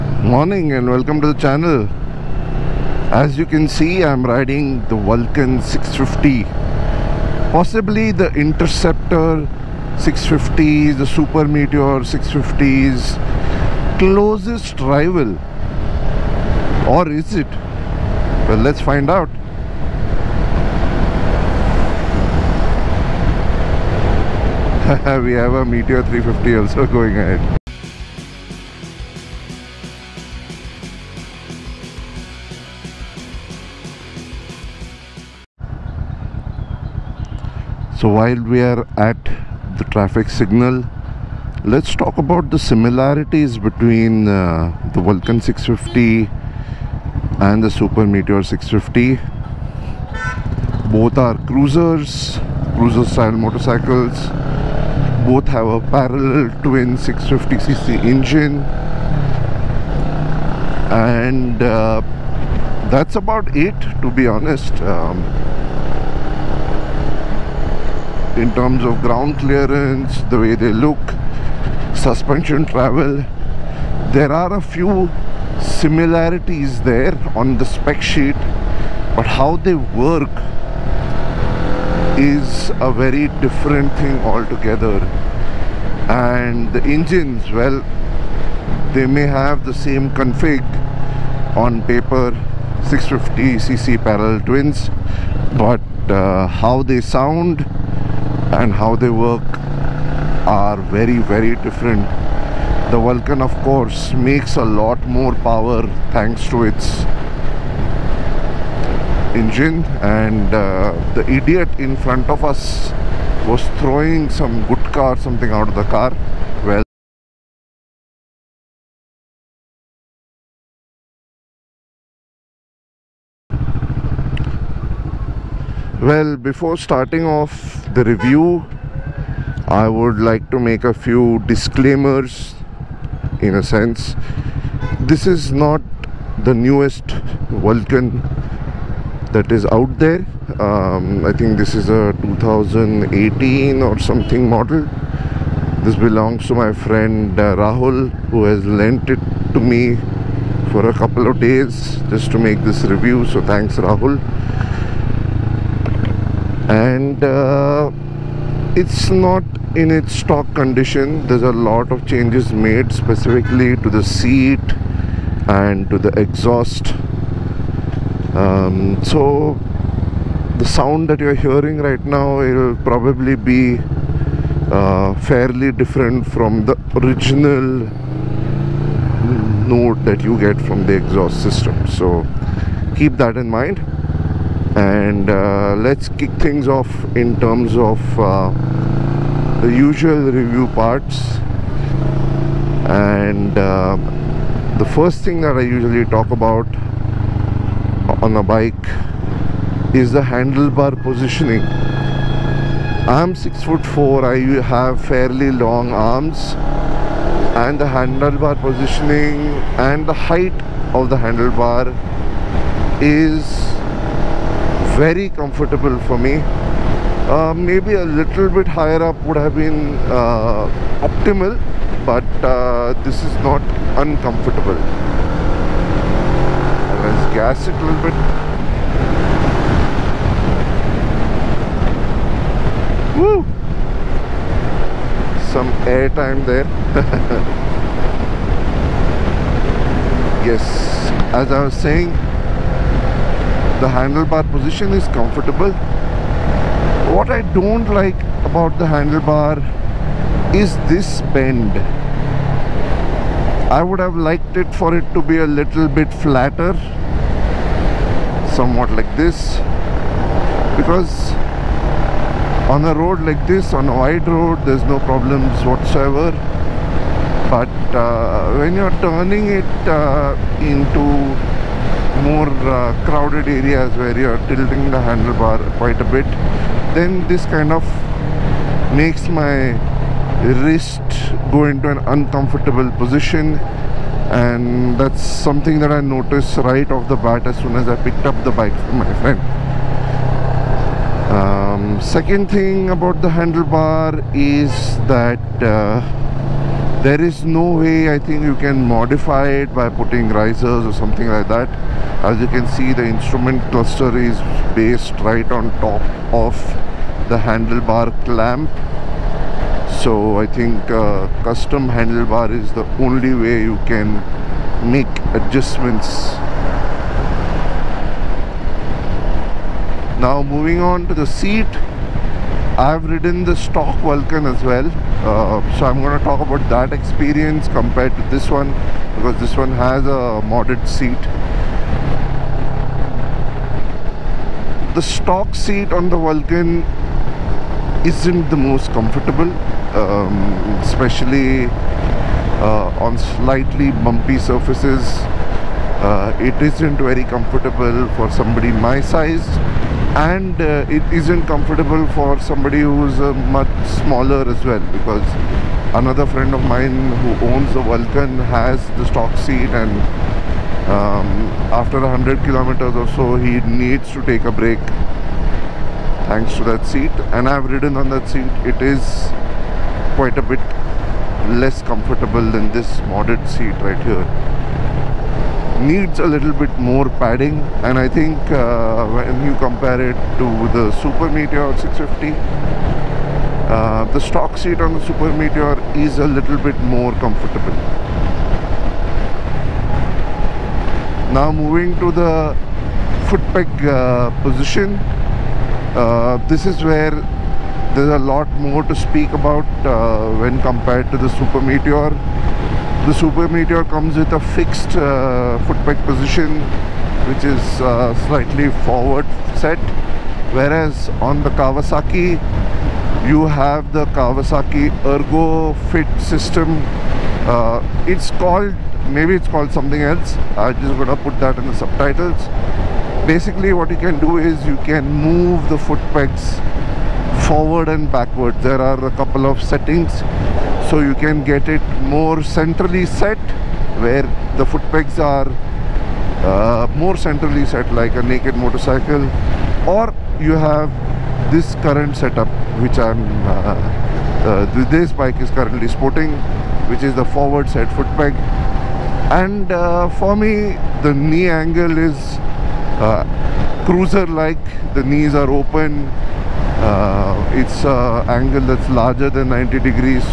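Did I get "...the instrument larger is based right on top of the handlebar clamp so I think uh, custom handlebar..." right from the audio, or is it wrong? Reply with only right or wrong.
wrong.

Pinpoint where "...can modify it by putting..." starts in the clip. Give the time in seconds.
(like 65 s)
298 s.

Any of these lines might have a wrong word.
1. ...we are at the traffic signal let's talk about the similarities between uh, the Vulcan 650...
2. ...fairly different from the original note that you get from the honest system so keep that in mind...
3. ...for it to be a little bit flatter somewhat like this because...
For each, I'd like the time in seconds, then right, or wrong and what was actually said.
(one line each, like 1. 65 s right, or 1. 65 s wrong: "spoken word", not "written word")
1. 38 s right
2. 175 s wrong: "exhaust", not "honest"
3. 254 s right.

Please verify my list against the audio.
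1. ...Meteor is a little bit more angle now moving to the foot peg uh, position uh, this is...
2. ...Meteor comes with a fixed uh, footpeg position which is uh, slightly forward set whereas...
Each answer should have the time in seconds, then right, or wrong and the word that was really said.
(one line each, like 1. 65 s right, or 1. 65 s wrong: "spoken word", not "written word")
1. 385 s wrong: "comfortable", not "angle"
2. 403 s right.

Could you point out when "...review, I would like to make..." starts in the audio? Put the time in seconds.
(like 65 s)
128 s.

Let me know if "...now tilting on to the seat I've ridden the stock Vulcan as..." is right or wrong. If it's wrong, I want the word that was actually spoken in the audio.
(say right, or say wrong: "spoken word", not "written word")
wrong: "moving", not "tilting".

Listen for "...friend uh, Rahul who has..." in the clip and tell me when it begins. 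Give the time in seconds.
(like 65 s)
146 s.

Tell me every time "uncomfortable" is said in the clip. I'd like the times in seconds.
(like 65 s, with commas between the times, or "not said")
224 s, 282 s.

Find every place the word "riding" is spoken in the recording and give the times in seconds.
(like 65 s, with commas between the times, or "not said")
4 s.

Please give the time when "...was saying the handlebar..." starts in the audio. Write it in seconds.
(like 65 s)
241 s.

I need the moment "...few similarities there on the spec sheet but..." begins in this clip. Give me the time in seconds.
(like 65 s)
74 s.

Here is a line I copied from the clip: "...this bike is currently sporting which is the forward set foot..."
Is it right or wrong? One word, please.
right.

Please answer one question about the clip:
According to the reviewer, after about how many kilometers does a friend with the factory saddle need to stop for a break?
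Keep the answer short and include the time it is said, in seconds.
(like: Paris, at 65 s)
100 kilometers, at 361 s.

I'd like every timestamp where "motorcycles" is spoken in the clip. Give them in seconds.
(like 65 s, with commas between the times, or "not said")
53 s, 438 s.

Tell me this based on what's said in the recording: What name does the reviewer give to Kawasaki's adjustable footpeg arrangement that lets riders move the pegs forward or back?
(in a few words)
Kawasaki Ergo Fit.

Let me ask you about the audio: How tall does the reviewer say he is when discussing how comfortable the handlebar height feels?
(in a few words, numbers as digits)
6 foot 4.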